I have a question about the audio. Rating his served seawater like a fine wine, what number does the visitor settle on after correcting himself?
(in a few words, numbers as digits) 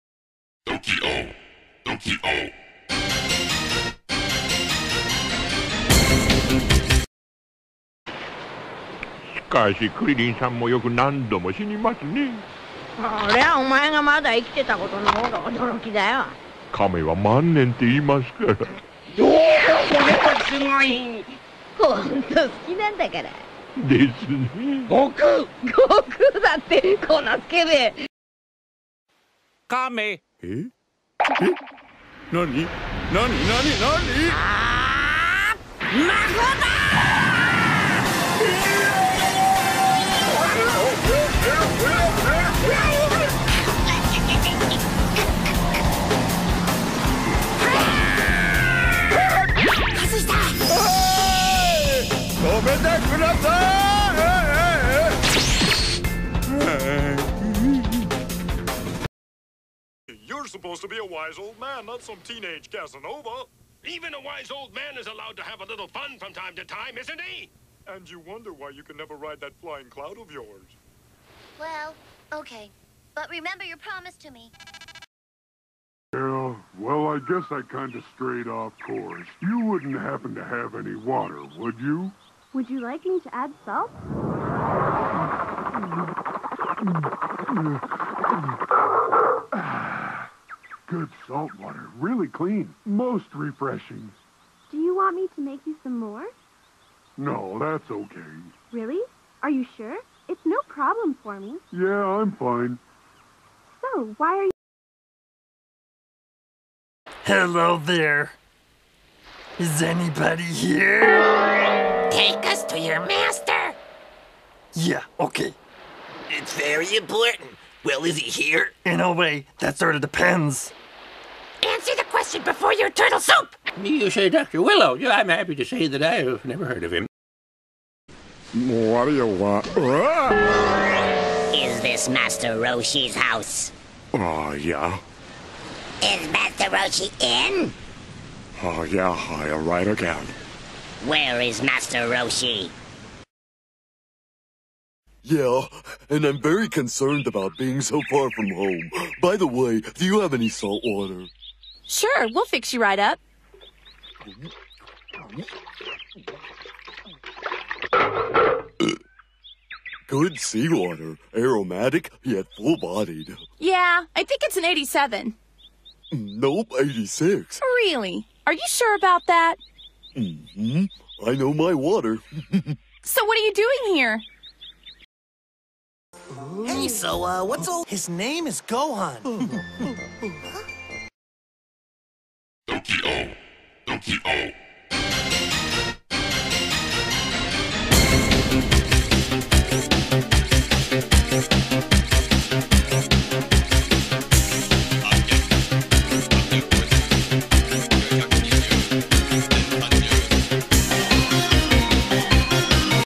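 86.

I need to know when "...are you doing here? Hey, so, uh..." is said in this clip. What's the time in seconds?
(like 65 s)
173 s.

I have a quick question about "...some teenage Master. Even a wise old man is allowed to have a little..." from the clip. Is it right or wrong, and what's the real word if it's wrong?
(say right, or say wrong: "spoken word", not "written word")
wrong: "Casanova", not "Master".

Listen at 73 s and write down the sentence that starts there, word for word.
But remember your promise to me.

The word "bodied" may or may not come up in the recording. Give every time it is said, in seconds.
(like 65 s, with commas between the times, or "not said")
162 s.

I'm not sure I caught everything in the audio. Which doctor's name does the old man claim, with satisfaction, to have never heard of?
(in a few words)
Dr. Willow.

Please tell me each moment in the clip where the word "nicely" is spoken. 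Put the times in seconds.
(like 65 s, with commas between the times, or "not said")
not said.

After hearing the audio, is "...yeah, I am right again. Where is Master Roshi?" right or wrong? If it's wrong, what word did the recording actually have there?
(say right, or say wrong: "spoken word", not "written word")
right.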